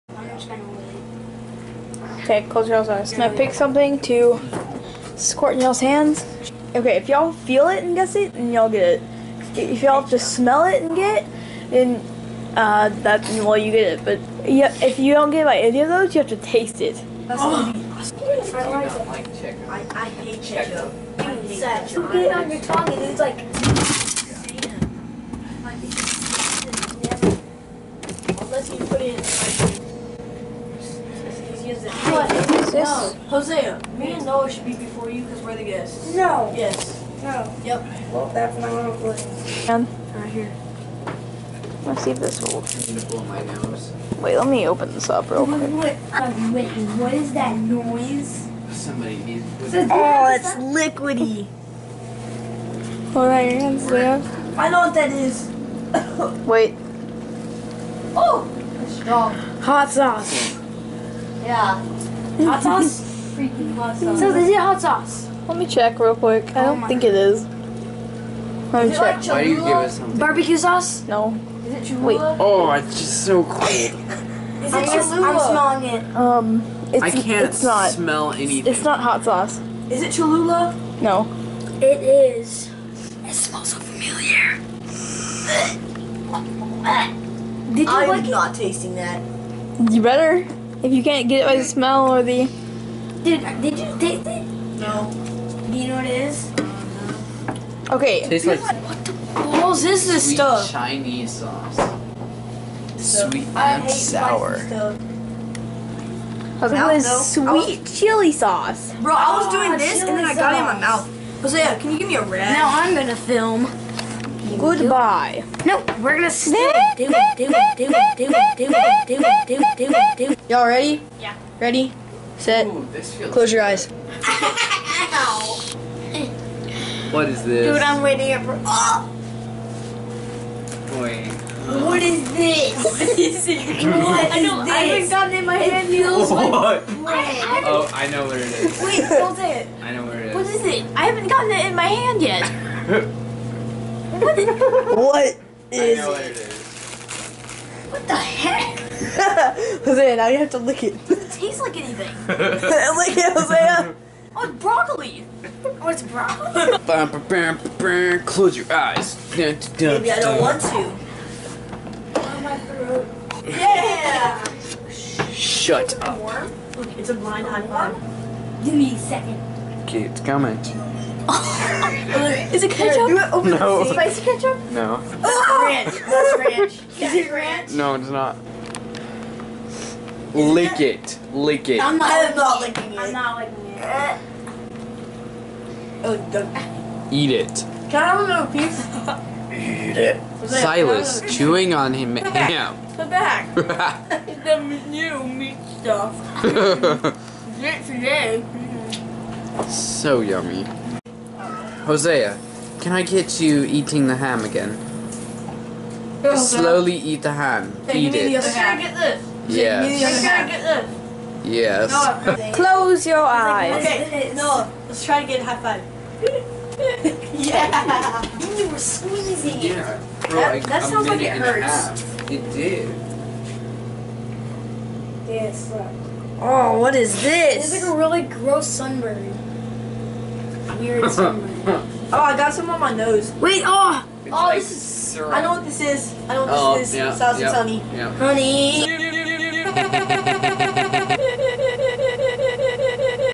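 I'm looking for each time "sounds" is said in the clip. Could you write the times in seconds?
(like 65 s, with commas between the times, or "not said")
220 s.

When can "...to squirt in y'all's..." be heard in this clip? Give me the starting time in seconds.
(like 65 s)
4 s.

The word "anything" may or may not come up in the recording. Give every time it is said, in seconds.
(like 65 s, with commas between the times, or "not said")
78 s, 151 s.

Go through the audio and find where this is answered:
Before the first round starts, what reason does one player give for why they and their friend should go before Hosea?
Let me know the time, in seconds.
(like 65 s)
35 s.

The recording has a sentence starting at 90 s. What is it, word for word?
If you can't get it by the smell or the.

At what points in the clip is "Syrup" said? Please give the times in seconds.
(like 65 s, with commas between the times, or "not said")
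235 s.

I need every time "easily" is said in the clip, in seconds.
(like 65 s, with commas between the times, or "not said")
not said.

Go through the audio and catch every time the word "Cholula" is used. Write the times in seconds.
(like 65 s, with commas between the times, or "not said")
71 s, 80 s.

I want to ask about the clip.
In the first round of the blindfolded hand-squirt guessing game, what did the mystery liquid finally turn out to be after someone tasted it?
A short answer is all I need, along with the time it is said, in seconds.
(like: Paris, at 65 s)
Sweet and sour, at 102 s.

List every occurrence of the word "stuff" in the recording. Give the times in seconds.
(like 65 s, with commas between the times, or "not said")
100 s, 195 s.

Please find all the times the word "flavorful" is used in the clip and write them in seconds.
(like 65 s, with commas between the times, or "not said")
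not said.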